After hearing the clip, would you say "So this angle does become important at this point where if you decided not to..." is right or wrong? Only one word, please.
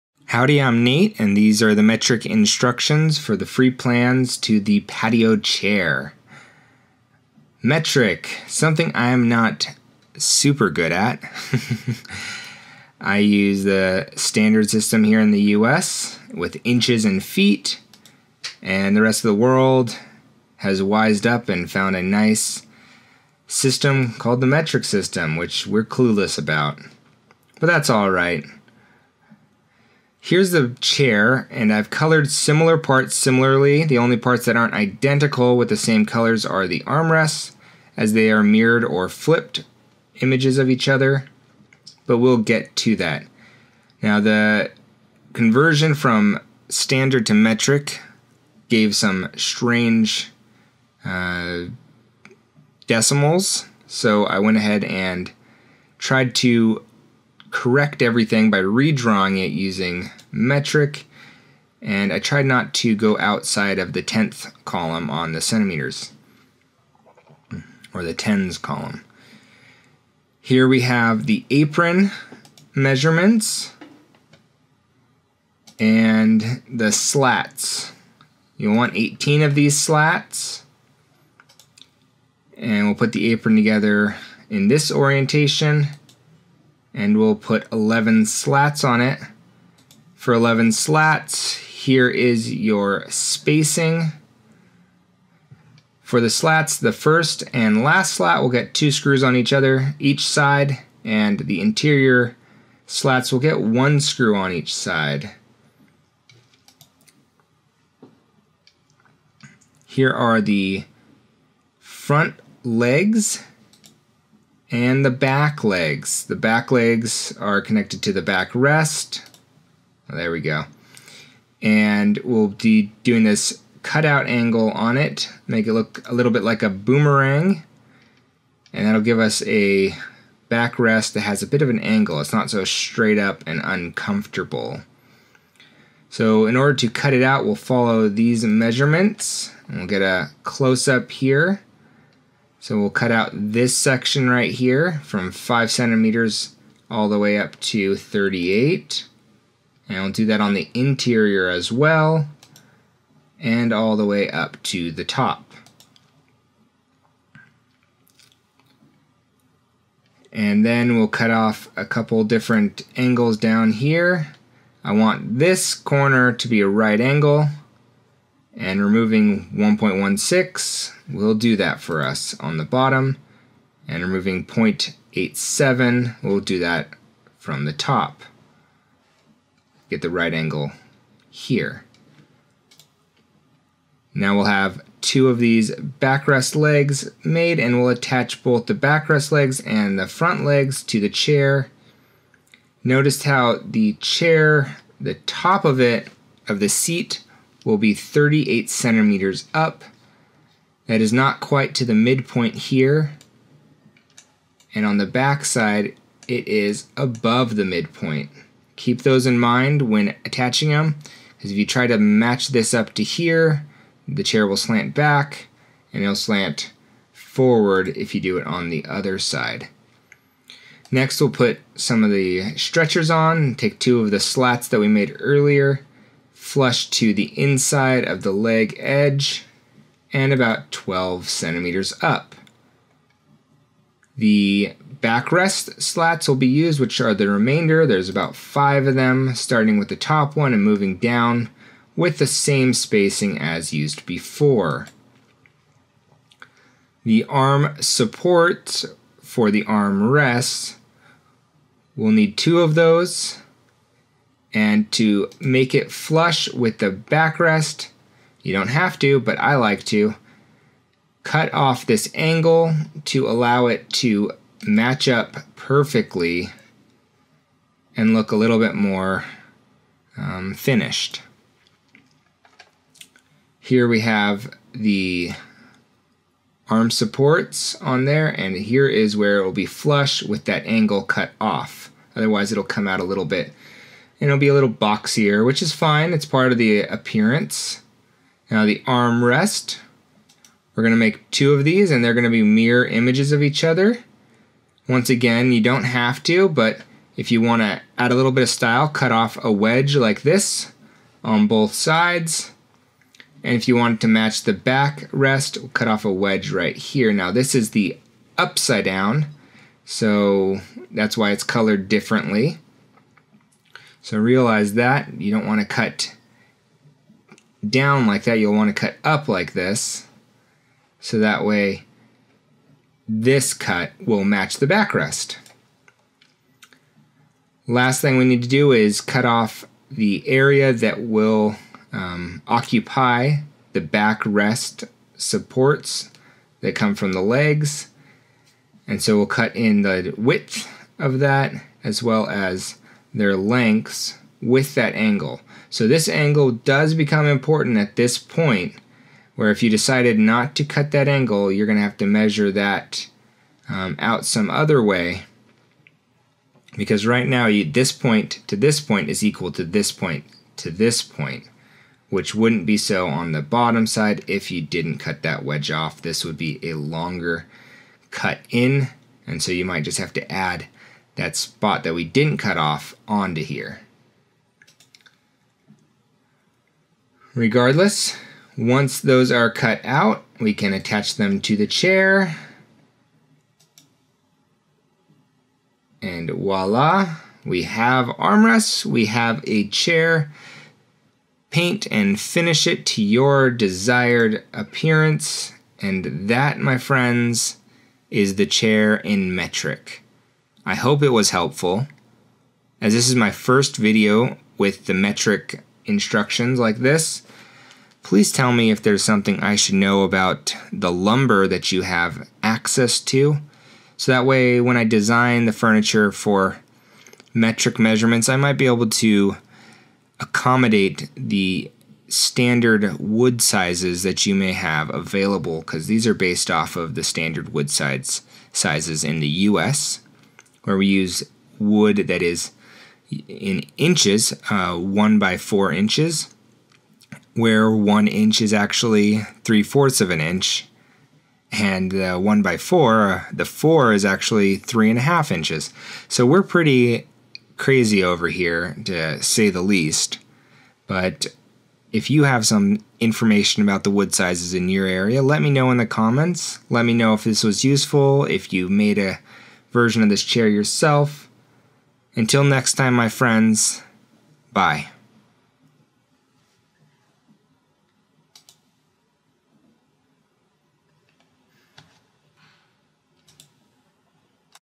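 right.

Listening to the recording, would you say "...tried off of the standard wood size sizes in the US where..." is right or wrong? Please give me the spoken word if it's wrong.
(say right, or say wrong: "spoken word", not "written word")
wrong: "based", not "tried".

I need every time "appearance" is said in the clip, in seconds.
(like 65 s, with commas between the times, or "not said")
286 s, 394 s.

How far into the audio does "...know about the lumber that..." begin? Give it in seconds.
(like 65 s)
409 s.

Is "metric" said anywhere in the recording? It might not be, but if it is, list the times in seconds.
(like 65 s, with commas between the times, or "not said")
1 s, 7 s, 24 s, 47 s, 60 s, 399 s, 404 s, 417 s.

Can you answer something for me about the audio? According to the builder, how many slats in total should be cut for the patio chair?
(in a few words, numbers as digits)
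18.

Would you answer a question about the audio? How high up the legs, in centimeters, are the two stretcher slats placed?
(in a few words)
12 centimeters.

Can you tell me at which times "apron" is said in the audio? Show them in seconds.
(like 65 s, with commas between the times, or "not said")
71 s, 83 s.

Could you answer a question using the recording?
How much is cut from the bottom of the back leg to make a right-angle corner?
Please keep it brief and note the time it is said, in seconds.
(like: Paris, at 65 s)
1.16, at 169 s.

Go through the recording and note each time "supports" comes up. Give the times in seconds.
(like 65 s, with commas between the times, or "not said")
247 s, 276 s, 335 s.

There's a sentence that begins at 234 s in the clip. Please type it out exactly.
The backrest slats will be used, which are the remainder.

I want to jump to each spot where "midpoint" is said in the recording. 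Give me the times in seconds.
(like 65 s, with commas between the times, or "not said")
201 s, 207 s.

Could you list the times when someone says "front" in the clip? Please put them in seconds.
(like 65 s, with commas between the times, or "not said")
111 s, 190 s.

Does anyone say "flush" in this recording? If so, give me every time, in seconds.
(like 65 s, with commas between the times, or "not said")
226 s, 255 s, 279 s.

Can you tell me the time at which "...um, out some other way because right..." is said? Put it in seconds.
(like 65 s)
353 s.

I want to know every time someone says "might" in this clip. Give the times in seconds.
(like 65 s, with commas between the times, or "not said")
369 s, 418 s.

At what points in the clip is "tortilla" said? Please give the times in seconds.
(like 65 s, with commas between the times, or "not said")
not said.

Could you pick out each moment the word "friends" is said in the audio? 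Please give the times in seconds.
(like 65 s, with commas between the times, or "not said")
396 s, 463 s.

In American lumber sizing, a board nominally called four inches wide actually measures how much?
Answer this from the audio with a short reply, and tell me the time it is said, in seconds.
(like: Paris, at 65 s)
3 and a half inches, at 444 s.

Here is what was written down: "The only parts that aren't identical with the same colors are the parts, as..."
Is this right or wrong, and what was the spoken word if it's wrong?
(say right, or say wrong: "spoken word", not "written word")
wrong: "armrests", not "parts".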